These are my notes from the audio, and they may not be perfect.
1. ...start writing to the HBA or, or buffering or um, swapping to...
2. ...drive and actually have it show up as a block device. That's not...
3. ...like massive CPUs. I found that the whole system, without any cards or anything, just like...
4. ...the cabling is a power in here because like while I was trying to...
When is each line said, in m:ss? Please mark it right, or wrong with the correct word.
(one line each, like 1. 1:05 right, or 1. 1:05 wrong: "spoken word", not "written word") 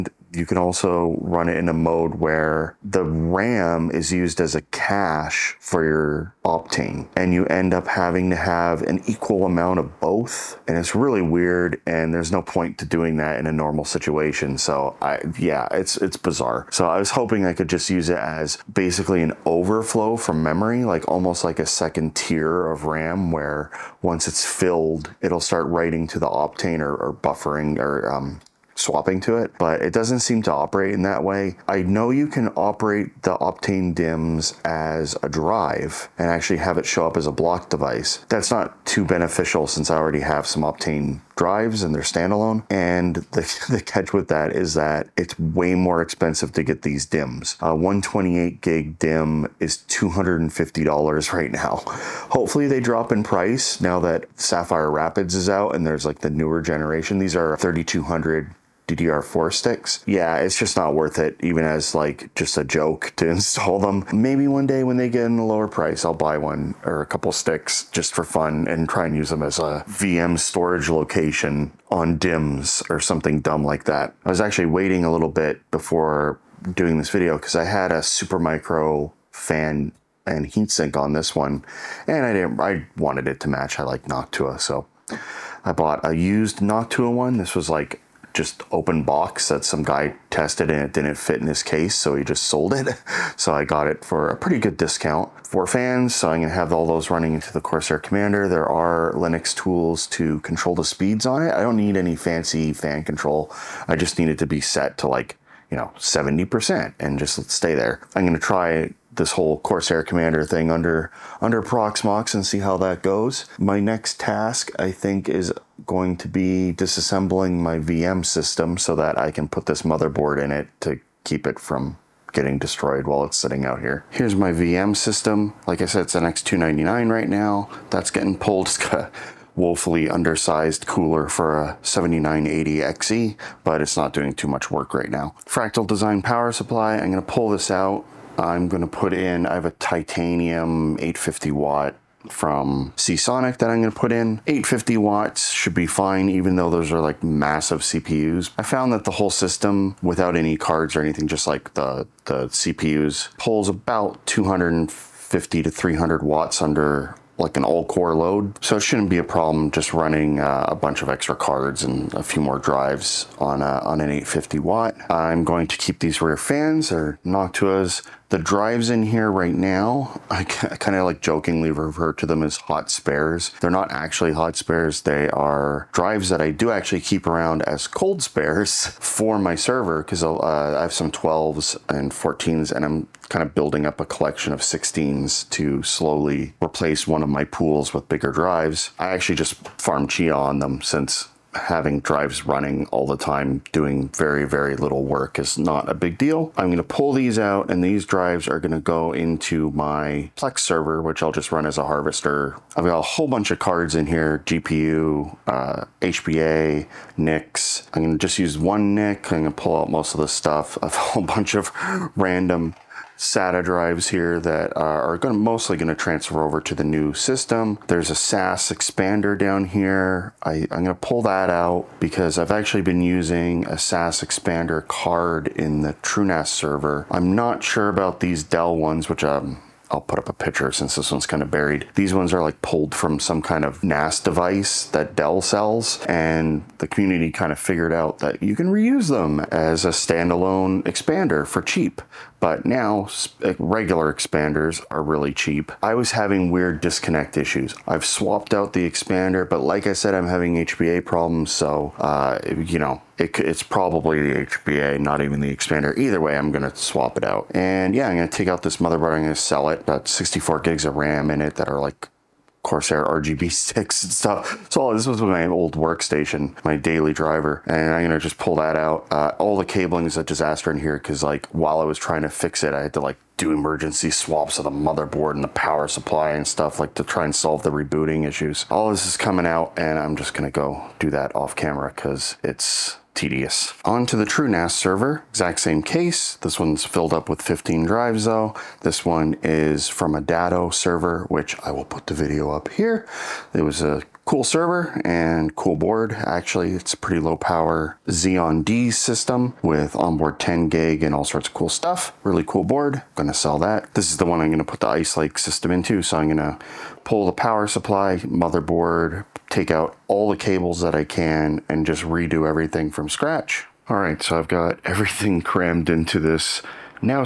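1. 0:25 wrong: "Optane", not "HBA"
2. 0:35 right
3. 2:27 right
4. 4:29 wrong: "disaster", not "power".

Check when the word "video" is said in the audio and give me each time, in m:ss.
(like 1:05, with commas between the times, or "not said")
1:17, 4:52.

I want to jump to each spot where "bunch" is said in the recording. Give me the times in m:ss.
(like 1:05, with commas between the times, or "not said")
2:40, 3:23, 3:31.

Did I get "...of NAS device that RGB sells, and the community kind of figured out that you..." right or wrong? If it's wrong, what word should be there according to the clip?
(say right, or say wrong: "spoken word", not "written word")
wrong: "Dell", not "RGB".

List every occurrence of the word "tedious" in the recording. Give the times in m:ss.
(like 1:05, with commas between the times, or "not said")
4:43.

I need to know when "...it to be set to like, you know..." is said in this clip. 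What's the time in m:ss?
1:44.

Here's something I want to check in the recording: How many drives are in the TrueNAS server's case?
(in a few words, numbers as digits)
15.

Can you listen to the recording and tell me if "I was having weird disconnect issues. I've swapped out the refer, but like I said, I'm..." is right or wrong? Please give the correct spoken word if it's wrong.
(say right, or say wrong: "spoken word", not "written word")
wrong: "expander", not "refer".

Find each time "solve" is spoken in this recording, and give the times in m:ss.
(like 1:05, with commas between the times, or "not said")
4:37.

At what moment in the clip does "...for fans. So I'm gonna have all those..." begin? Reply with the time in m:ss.
1:35.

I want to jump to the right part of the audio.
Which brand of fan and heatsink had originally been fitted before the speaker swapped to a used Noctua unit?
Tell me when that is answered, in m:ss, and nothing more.
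1:18.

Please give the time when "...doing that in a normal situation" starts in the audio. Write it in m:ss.
0:12.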